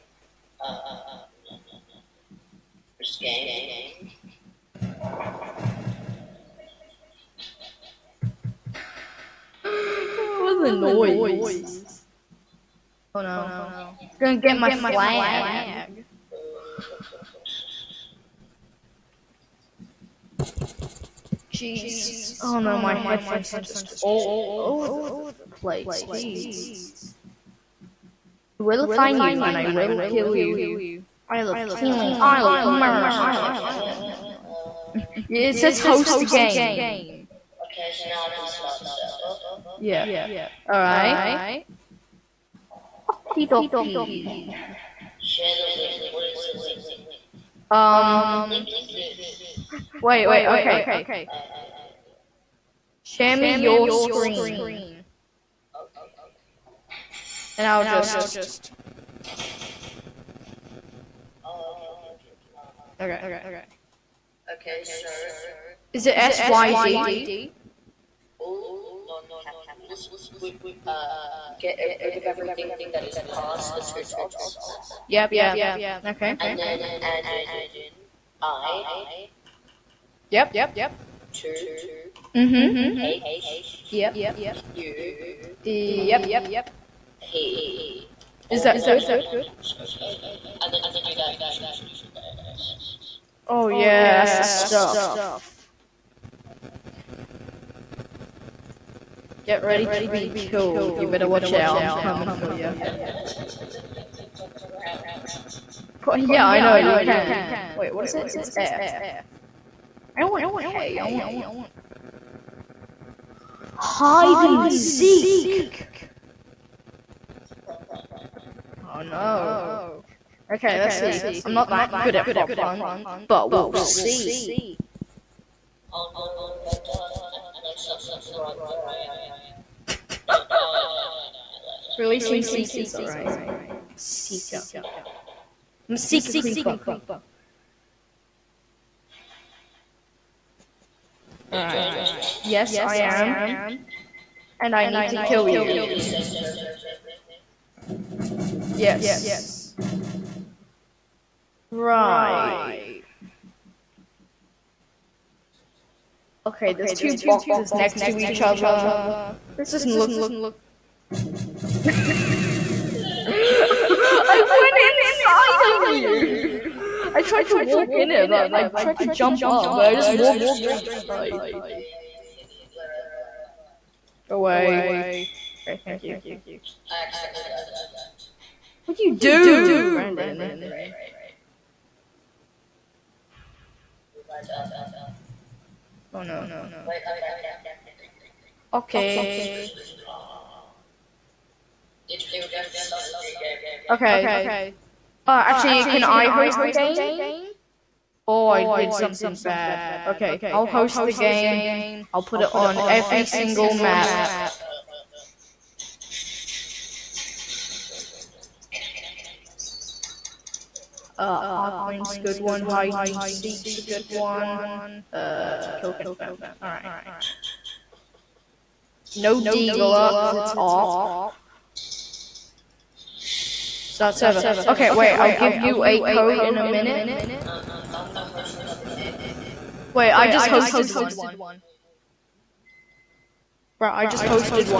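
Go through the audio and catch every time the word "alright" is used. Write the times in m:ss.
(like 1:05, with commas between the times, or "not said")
0:40, 2:12, 3:36.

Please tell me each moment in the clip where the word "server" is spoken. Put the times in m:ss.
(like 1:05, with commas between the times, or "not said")
0:38, 3:44.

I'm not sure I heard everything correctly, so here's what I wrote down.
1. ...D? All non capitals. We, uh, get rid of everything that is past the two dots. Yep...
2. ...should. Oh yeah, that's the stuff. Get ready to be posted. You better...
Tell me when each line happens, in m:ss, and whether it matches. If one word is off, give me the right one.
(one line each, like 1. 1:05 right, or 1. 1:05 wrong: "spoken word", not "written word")
1. 1:06 right
2. 1:31 wrong: "killed", not "posted".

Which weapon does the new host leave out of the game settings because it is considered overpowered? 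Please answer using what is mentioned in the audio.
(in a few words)
Deagle.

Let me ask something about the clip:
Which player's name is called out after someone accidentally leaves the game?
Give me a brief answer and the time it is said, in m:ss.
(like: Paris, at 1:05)
Brandon, at 2:59.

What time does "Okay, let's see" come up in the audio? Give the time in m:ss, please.
2:00.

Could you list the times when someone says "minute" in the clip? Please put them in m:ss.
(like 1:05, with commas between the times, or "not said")
3:46.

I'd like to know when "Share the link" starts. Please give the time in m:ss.
0:45.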